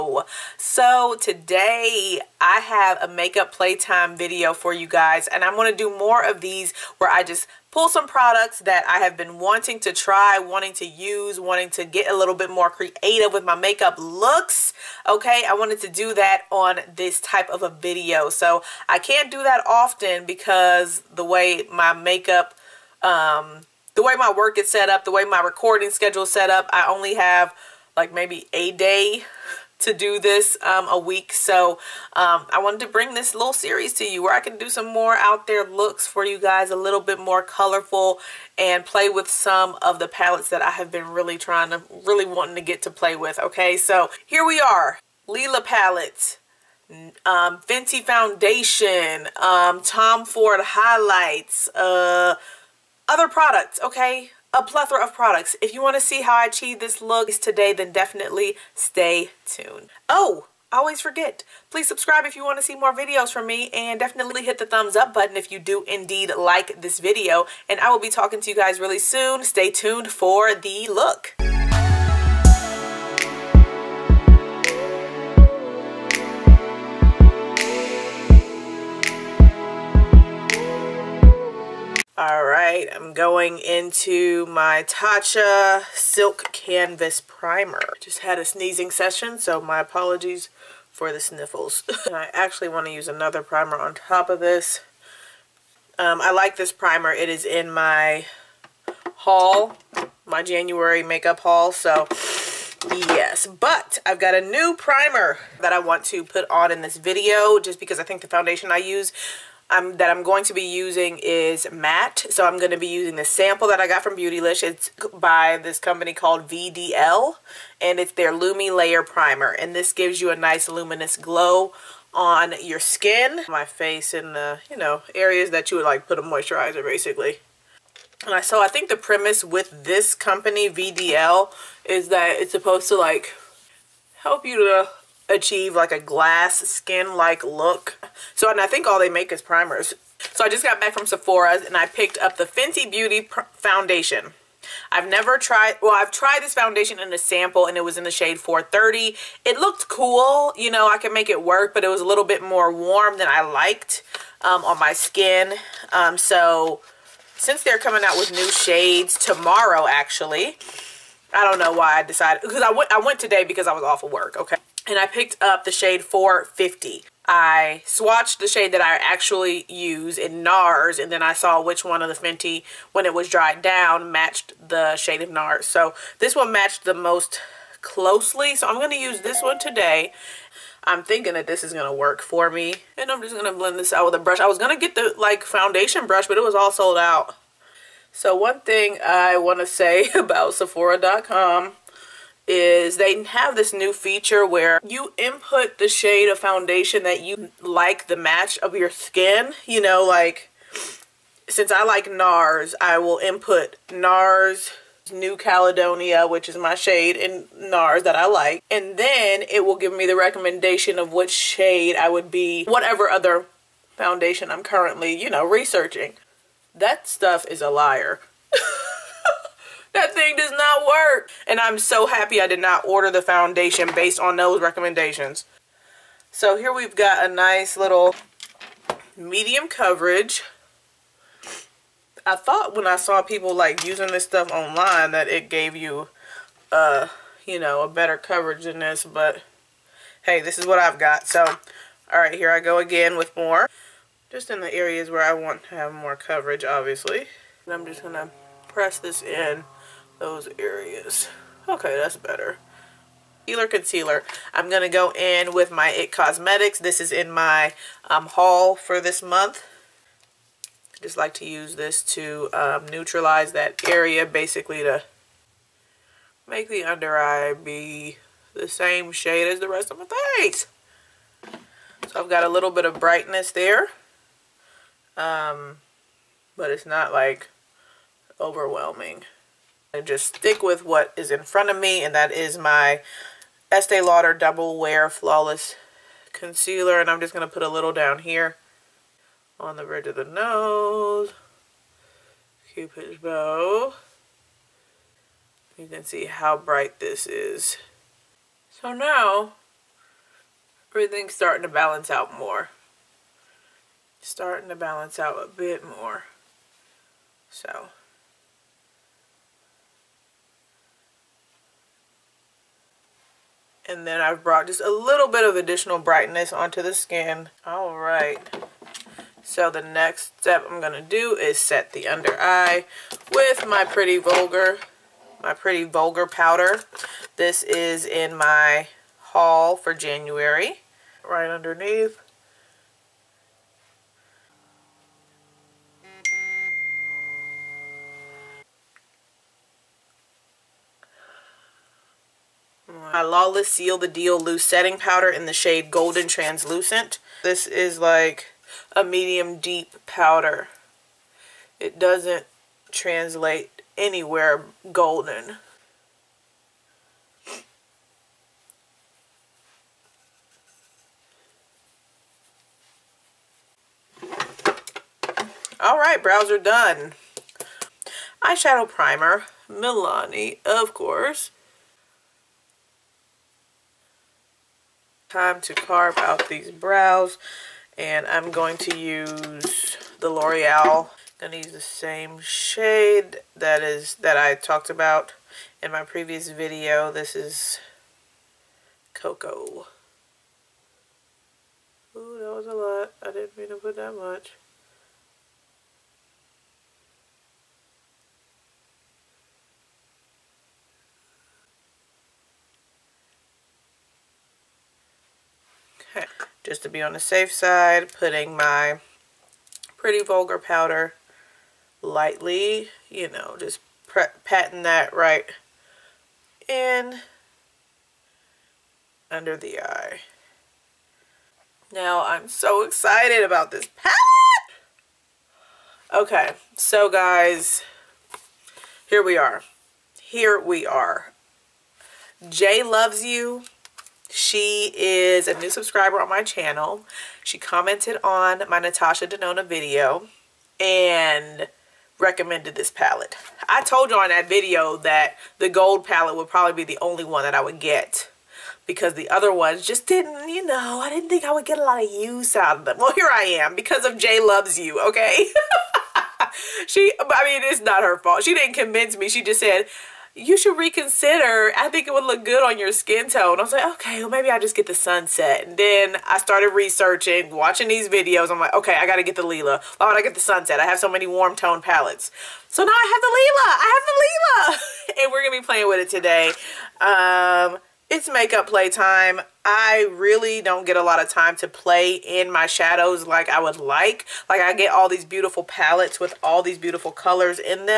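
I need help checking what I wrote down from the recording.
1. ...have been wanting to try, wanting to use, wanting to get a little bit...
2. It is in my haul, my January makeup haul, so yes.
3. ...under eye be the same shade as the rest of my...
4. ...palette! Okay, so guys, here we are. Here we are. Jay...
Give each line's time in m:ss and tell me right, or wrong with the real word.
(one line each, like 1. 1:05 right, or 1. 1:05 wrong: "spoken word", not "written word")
1. 0:08 right
2. 1:37 right
3. 4:26 right
4. 7:03 right.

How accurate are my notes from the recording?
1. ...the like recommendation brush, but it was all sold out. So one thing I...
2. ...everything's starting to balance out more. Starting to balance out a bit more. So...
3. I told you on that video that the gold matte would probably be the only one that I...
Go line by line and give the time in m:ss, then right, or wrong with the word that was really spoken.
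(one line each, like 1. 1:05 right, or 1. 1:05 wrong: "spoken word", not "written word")
1. 3:04 wrong: "foundation", not "recommendation"
2. 5:00 right
3. 7:23 wrong: "palette", not "matte".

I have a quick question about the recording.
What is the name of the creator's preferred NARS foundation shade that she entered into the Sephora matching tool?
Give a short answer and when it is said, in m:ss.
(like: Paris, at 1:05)
New Caledonia, at 3:25.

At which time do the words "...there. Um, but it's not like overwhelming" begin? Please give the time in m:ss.
4:33.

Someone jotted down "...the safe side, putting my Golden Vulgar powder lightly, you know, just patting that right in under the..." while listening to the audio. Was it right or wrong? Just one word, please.
wrong.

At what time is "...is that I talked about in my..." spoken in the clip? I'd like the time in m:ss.
6:23.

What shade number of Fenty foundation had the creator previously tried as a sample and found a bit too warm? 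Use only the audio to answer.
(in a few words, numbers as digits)
430.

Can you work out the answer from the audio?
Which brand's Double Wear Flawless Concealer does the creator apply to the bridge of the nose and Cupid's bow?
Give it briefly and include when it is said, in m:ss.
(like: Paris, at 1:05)
Estee Lauder, at 4:43.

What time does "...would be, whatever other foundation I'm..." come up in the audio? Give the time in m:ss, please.
3:32.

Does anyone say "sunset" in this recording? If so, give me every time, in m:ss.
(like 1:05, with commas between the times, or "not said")
7:44, 7:50.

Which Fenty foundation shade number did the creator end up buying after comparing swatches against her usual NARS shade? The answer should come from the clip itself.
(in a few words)
450.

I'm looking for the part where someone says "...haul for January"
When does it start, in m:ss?
5:29.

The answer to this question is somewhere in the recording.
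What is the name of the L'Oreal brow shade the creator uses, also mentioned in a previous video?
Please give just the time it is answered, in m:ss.
6:29.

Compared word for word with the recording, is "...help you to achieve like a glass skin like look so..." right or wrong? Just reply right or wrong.
right.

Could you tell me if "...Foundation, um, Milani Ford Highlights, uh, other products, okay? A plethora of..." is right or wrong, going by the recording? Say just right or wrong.
wrong.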